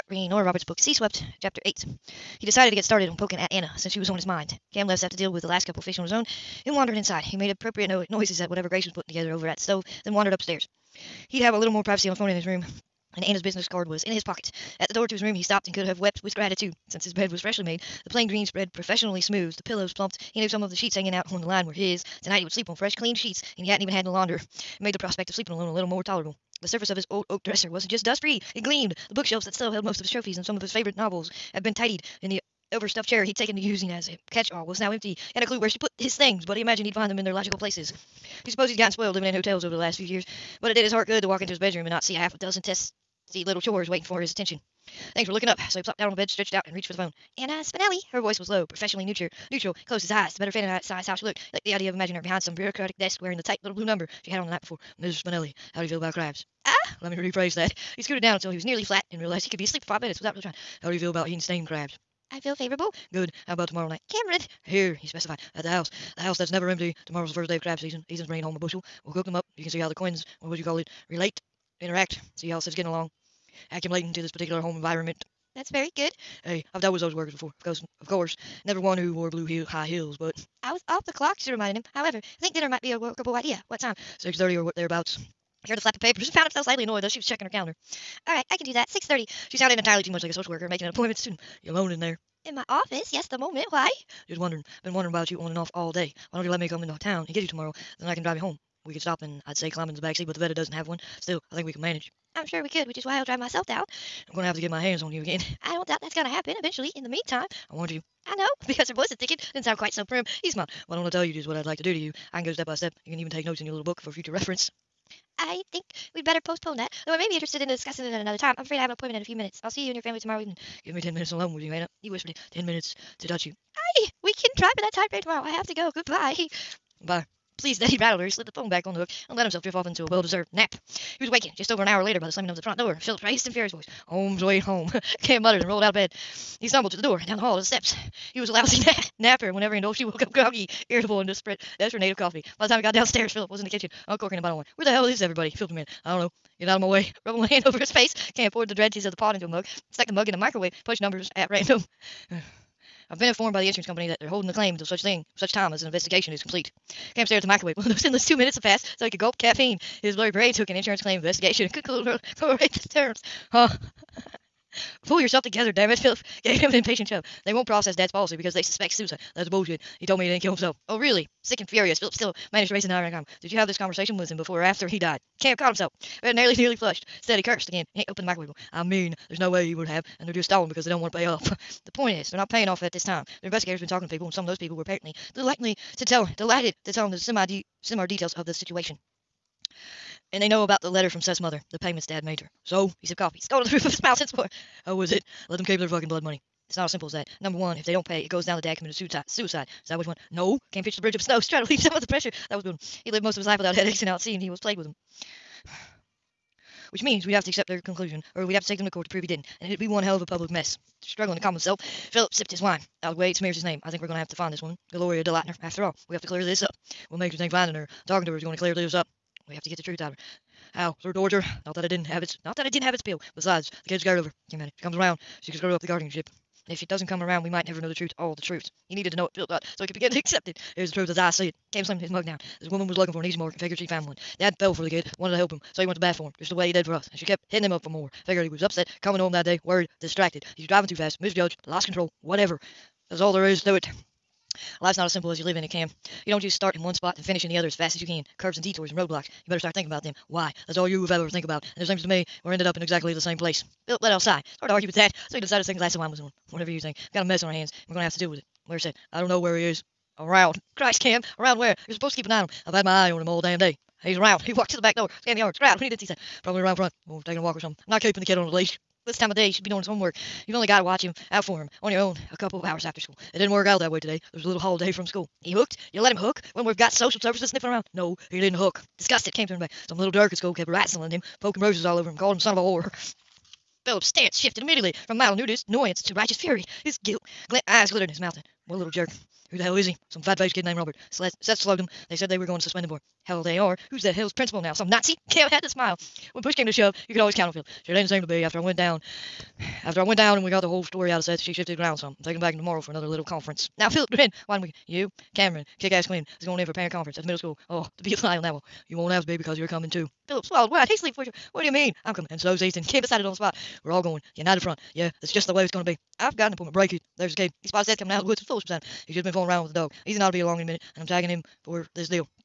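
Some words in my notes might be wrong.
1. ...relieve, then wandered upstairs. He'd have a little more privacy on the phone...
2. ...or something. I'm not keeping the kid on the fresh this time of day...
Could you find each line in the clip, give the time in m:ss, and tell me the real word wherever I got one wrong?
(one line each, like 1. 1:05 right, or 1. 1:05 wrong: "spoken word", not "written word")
1. 0:09 wrong: "stove", not "relieve"
2. 4:27 wrong: "leash", not "fresh".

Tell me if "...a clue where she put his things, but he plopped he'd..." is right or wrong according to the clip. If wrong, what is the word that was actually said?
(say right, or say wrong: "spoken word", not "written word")
wrong: "imagined", not "plopped".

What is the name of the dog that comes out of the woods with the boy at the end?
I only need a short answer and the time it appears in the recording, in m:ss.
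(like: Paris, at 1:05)
Foolish, at 5:18.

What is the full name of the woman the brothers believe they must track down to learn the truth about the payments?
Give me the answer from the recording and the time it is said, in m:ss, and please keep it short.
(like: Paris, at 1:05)
Gloria DeLauter, at 3:34.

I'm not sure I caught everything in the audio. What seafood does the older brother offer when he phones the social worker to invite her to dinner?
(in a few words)
Steamed crabs.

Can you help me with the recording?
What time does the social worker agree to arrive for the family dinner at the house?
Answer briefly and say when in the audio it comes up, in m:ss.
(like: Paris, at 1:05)
6:30, at 1:28.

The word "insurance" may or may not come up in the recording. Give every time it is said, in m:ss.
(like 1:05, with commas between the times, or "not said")
2:33, 2:40.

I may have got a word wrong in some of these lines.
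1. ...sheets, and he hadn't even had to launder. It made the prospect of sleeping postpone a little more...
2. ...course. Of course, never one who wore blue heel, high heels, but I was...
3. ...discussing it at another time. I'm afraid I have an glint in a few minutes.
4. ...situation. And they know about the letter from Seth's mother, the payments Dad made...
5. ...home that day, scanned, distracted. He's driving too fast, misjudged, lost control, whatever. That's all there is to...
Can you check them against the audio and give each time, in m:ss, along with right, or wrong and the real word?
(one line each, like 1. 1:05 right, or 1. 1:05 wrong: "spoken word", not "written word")
1. 0:23 wrong: "alone", not "postpone"
2. 1:17 right
3. 1:57 wrong: "appointment", not "glint"
4. 3:08 right
5. 3:59 wrong: "worried", not "scanned".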